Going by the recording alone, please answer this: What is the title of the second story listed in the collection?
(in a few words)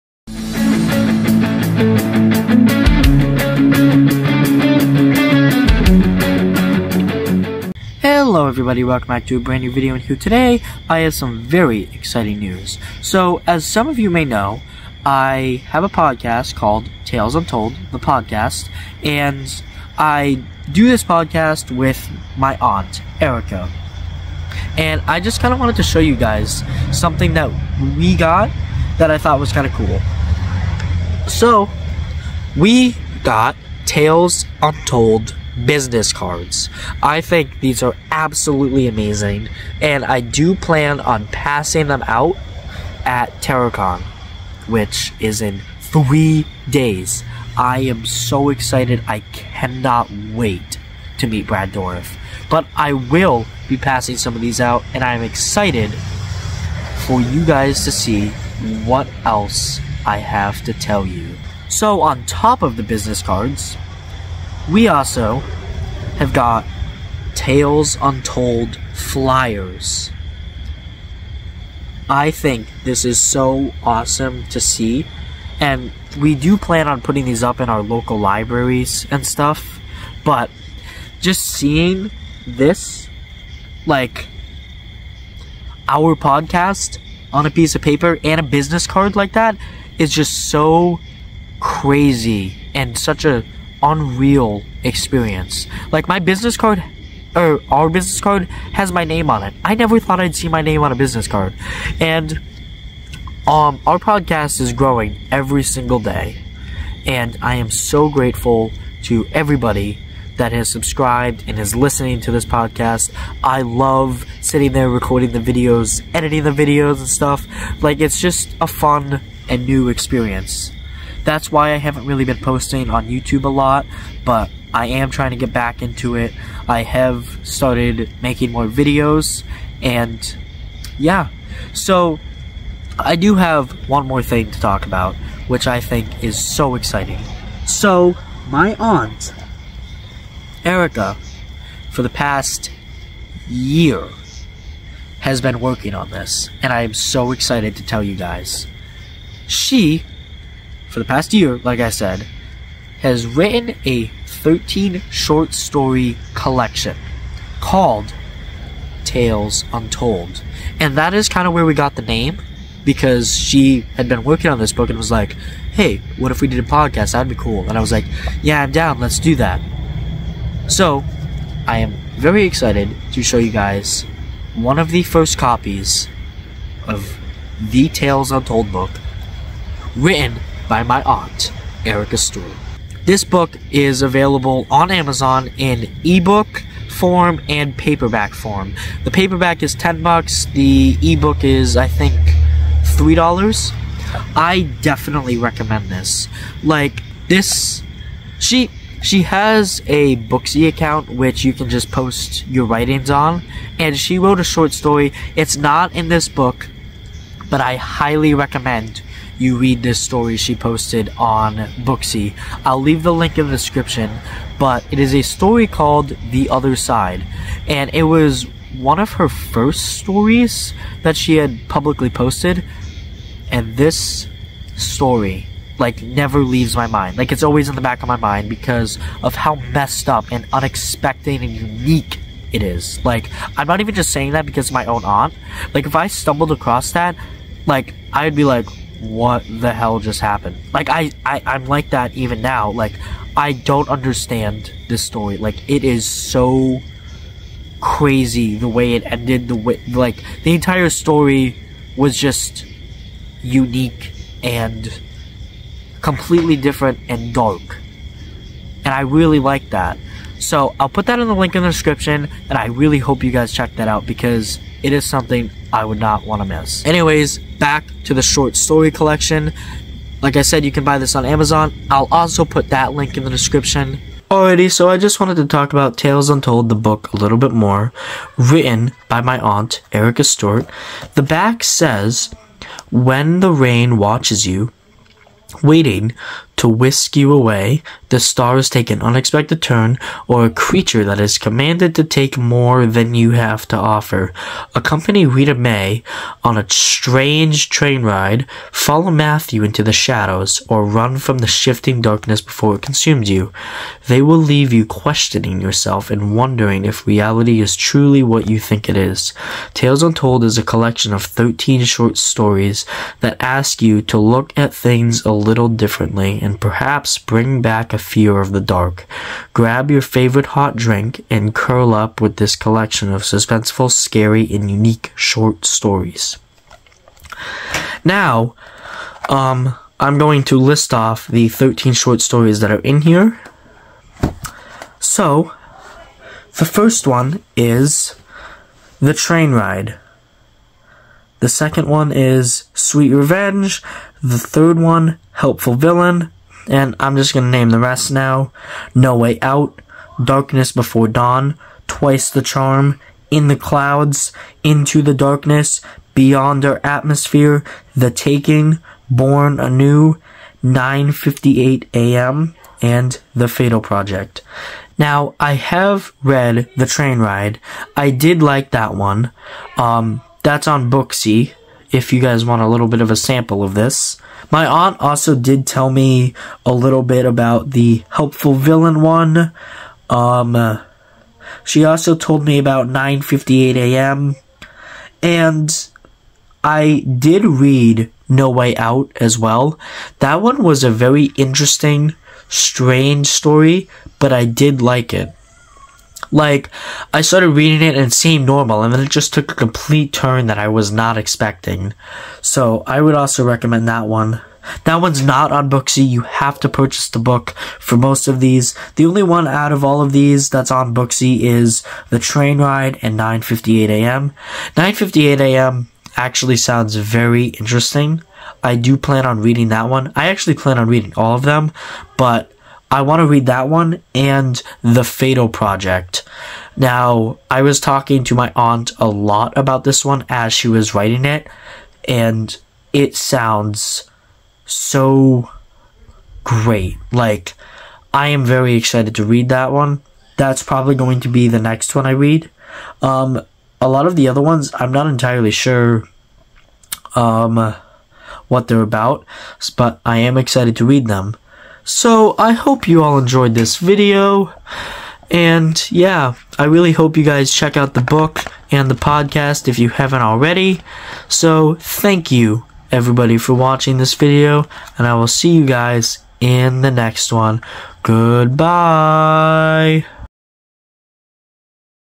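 Sweet Revenge.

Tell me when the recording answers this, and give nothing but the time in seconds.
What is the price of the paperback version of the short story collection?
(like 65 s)
189 s.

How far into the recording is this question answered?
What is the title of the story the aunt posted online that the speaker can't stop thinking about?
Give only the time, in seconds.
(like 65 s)
216 s.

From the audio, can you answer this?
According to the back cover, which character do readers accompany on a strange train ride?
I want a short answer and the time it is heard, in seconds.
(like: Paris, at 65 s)
Rita May, at 295 s.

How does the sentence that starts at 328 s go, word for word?
Now, um, I'm going to list off the 13 short stories that are in here.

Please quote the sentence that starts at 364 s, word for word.
Now, I have read The Train Ride.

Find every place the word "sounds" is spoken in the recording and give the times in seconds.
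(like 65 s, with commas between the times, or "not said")
416 s, 433 s.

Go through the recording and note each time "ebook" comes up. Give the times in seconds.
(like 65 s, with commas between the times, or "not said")
186 s, 191 s.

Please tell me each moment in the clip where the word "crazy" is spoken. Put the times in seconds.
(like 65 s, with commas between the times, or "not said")
91 s, 247 s.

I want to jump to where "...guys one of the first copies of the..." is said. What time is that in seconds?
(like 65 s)
173 s.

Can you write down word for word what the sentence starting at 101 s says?
And um, our podcast is growing every single day.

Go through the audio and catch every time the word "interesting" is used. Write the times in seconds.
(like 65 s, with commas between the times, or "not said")
391 s, 417 s.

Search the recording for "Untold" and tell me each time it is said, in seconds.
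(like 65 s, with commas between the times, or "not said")
17 s, 34 s, 68 s, 159 s, 178 s, 276 s, 310 s.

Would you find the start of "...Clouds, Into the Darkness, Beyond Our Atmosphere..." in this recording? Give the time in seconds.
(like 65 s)
353 s.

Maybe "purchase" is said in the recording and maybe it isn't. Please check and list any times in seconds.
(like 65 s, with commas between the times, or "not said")
406 s.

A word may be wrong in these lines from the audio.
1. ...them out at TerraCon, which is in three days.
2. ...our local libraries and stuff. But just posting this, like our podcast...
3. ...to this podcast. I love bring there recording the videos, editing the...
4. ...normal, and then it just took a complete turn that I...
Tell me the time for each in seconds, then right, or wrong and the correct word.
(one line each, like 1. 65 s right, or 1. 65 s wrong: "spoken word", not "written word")
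1. 41 s right
2. 77 s wrong: "seeing", not "posting"
3. 112 s wrong: "sitting", not "bring"
4. 398 s right.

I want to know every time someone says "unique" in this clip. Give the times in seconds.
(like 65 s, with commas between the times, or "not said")
231 s, 253 s, 324 s.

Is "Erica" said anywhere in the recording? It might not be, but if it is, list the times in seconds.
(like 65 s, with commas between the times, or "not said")
23 s, 140 s, 181 s, 279 s.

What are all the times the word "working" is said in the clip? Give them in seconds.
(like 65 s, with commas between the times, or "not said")
145 s, 164 s.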